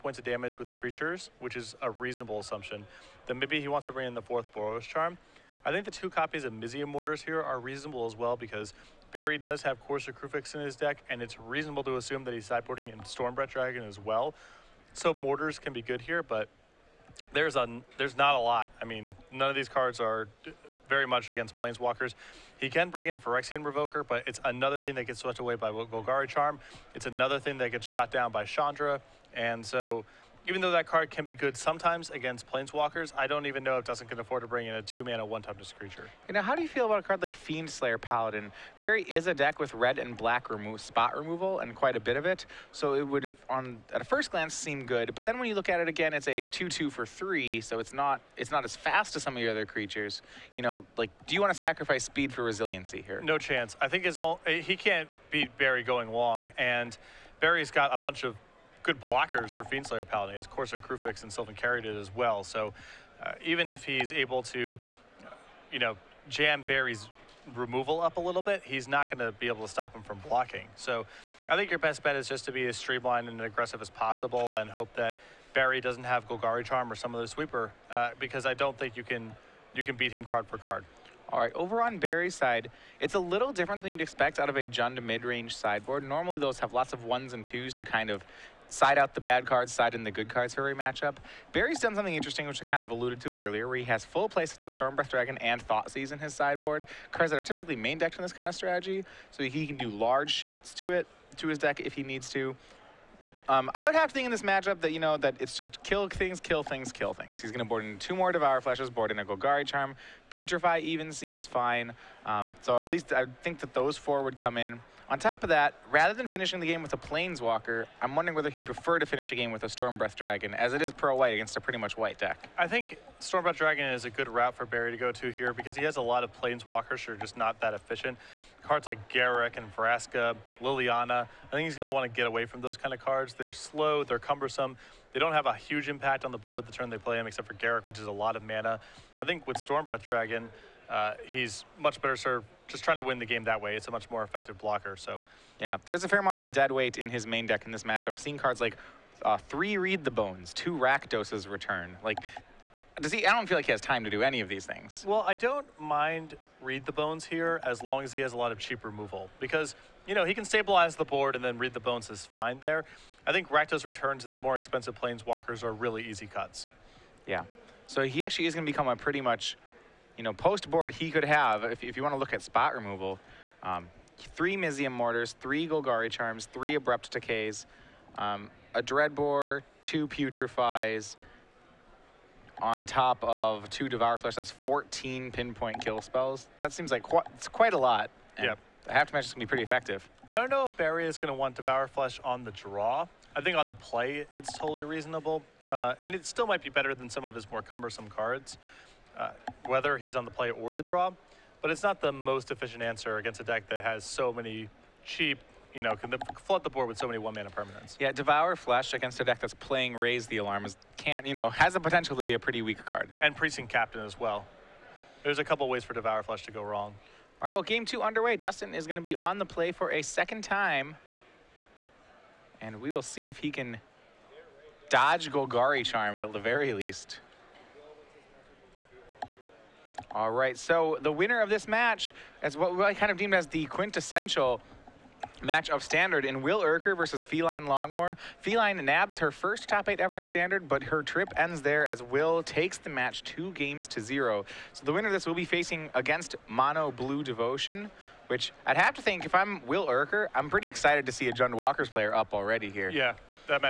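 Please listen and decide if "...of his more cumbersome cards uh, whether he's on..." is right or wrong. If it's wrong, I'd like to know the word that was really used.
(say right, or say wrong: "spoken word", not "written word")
right.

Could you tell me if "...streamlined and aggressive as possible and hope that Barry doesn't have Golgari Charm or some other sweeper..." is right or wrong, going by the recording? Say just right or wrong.
right.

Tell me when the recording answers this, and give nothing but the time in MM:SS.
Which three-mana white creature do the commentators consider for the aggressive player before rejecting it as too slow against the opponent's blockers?
00:37.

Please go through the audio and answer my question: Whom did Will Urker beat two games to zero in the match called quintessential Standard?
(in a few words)
Feline Longmore.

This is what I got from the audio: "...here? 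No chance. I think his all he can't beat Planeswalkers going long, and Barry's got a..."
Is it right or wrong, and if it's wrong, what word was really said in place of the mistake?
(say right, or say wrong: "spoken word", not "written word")
wrong: "Barry", not "Planeswalkers".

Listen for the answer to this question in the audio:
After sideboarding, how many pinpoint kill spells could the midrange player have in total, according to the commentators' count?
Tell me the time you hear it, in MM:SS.
03:04.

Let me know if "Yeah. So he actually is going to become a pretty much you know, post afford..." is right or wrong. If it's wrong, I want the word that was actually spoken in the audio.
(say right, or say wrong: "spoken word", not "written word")
wrong: "board", not "afford".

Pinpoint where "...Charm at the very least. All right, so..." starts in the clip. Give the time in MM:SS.
03:45.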